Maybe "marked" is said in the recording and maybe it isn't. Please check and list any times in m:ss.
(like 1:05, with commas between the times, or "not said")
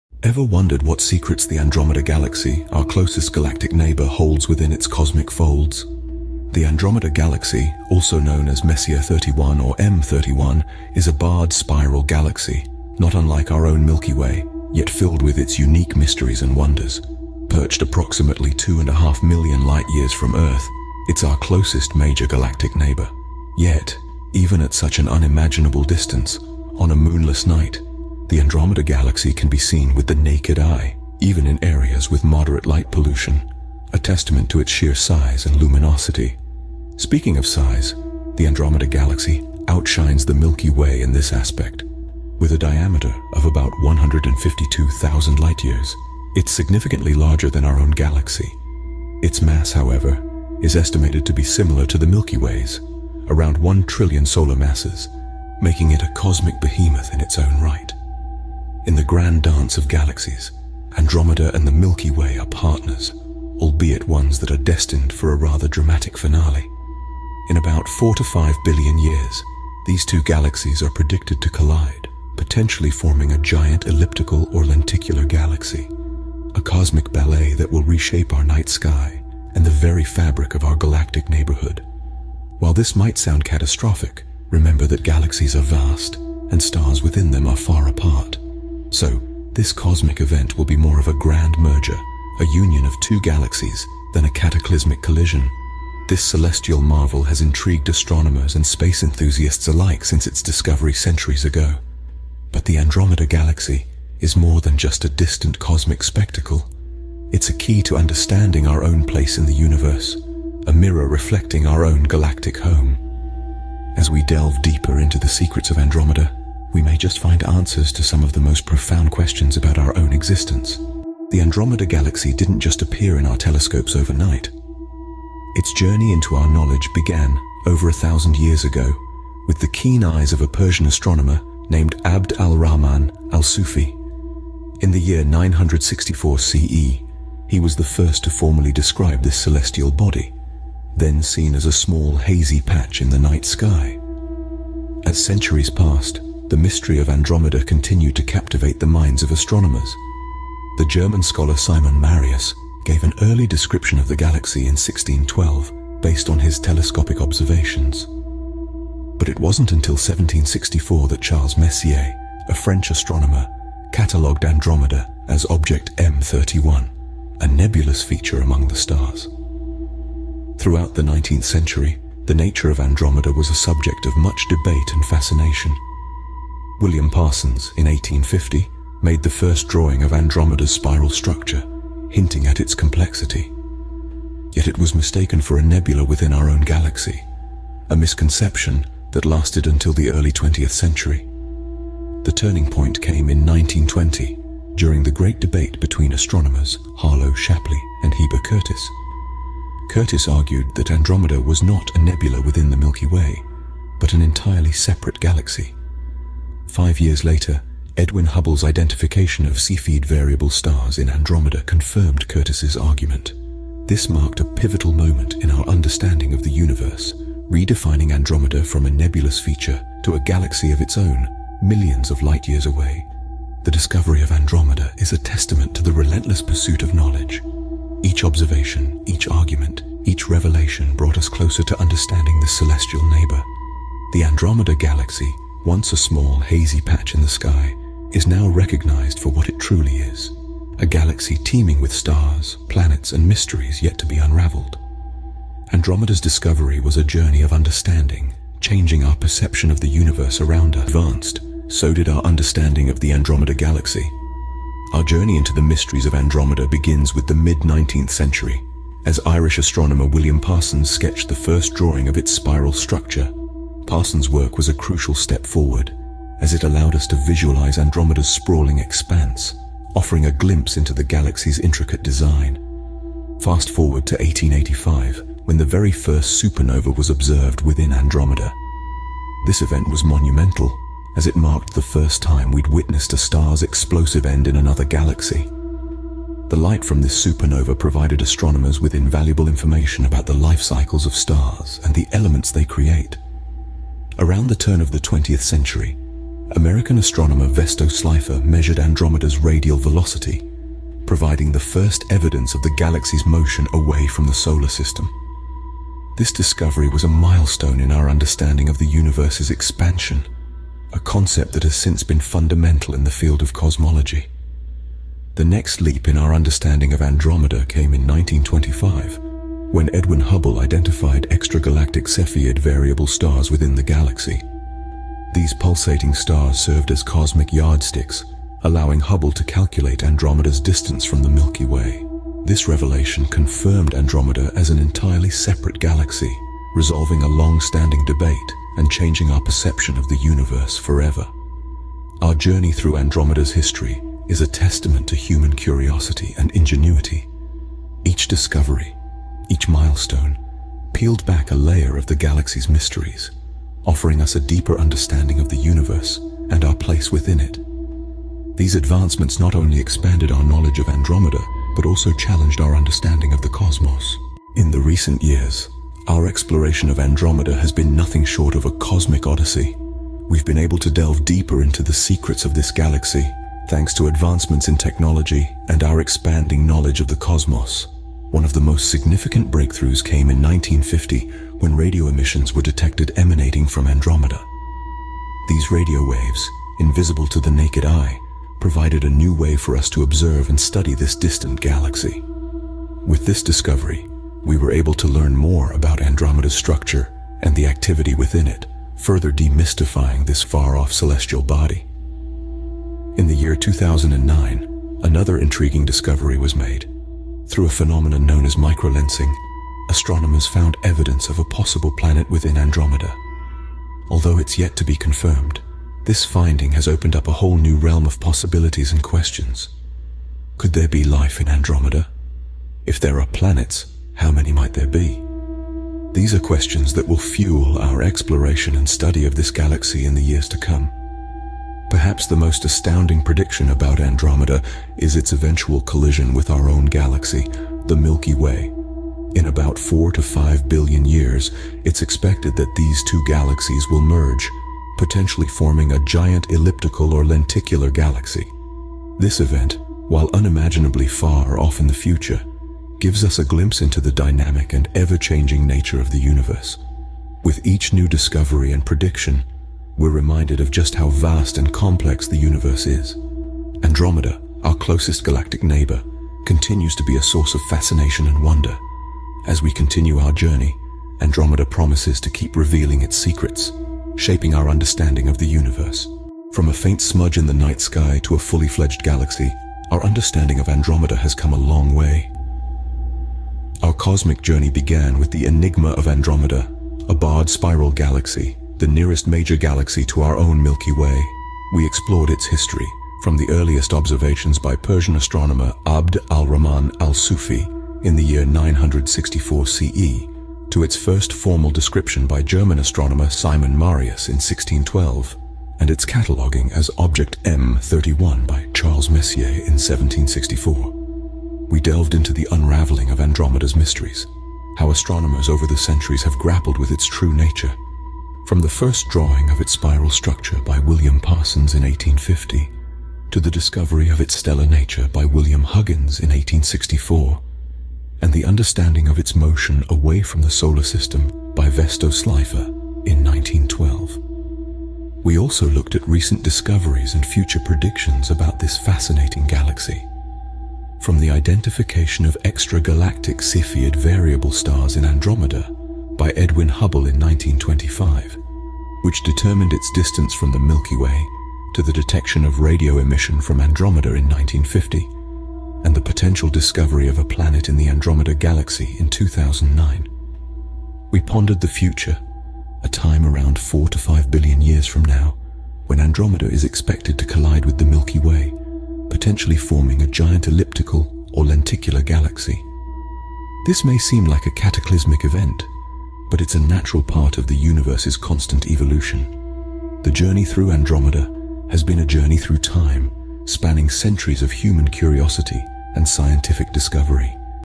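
3:34, 4:41.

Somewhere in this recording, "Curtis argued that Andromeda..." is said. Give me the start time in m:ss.
3:19.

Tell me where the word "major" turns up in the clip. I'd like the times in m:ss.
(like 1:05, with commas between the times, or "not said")
0:21, 8:09.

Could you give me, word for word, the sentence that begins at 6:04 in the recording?
In the recent years, our exploration of Andromeda has been nothing short of a cosmic odyssey.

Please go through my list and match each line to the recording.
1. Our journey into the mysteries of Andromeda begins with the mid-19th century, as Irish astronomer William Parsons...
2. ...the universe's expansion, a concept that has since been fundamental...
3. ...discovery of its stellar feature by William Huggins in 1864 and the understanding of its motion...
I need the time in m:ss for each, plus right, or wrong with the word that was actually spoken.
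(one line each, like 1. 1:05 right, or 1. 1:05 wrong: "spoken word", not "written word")
1. 4:14 right
2. 5:08 right
3. 8:43 wrong: "nature", not "feature".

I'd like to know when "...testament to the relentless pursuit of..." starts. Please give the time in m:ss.
3:45.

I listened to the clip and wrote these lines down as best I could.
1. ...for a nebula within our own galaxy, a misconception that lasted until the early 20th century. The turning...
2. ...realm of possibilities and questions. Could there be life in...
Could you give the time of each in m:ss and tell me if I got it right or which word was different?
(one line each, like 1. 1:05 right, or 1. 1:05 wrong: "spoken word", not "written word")
1. 3:05 right
2. 6:57 right.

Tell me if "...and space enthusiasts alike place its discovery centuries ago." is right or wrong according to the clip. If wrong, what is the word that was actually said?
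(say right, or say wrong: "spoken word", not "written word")
wrong: "since", not "place".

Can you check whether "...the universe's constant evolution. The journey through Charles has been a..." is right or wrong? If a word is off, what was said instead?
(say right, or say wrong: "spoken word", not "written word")
wrong: "Andromeda", not "Charles".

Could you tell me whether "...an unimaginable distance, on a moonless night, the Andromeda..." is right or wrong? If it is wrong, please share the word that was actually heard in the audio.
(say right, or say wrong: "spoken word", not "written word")
right.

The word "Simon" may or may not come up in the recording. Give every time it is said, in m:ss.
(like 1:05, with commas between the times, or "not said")
2:31, 8:23.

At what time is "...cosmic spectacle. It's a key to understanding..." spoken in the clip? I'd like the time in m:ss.
1:45.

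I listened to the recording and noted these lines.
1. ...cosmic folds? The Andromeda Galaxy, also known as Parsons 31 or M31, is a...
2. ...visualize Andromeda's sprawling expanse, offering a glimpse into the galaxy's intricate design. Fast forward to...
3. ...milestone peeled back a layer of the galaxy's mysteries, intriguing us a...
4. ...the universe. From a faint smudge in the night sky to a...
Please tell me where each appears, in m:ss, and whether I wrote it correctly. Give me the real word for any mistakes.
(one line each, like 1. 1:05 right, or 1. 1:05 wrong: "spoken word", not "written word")
1. 0:04 wrong: "Messier", not "Parsons"
2. 4:27 right
3. 5:49 wrong: "offering", not "intriguing"
4. 7:55 right.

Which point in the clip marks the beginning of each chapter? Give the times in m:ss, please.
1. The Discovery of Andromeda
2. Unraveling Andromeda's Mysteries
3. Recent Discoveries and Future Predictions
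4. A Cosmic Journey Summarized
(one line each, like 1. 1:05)
1. 2:01
2. 4:11
3. 6:05
4. 7:57.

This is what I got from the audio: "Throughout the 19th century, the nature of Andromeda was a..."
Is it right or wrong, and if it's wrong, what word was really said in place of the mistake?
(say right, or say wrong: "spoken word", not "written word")
right.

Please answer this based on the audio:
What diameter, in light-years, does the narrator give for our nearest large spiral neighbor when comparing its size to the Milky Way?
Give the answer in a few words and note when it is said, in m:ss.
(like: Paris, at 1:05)
152,000 light-years, at 0:43.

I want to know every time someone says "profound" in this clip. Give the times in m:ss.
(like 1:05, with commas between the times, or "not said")
1:58.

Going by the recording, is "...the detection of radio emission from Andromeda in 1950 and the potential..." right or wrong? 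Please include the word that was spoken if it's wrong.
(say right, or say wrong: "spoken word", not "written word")
right.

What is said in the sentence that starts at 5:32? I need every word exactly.
This revelation confirmed Andromeda as an entirely separate galaxy, resolving a long-standing debate and changing our perception of the universe forever.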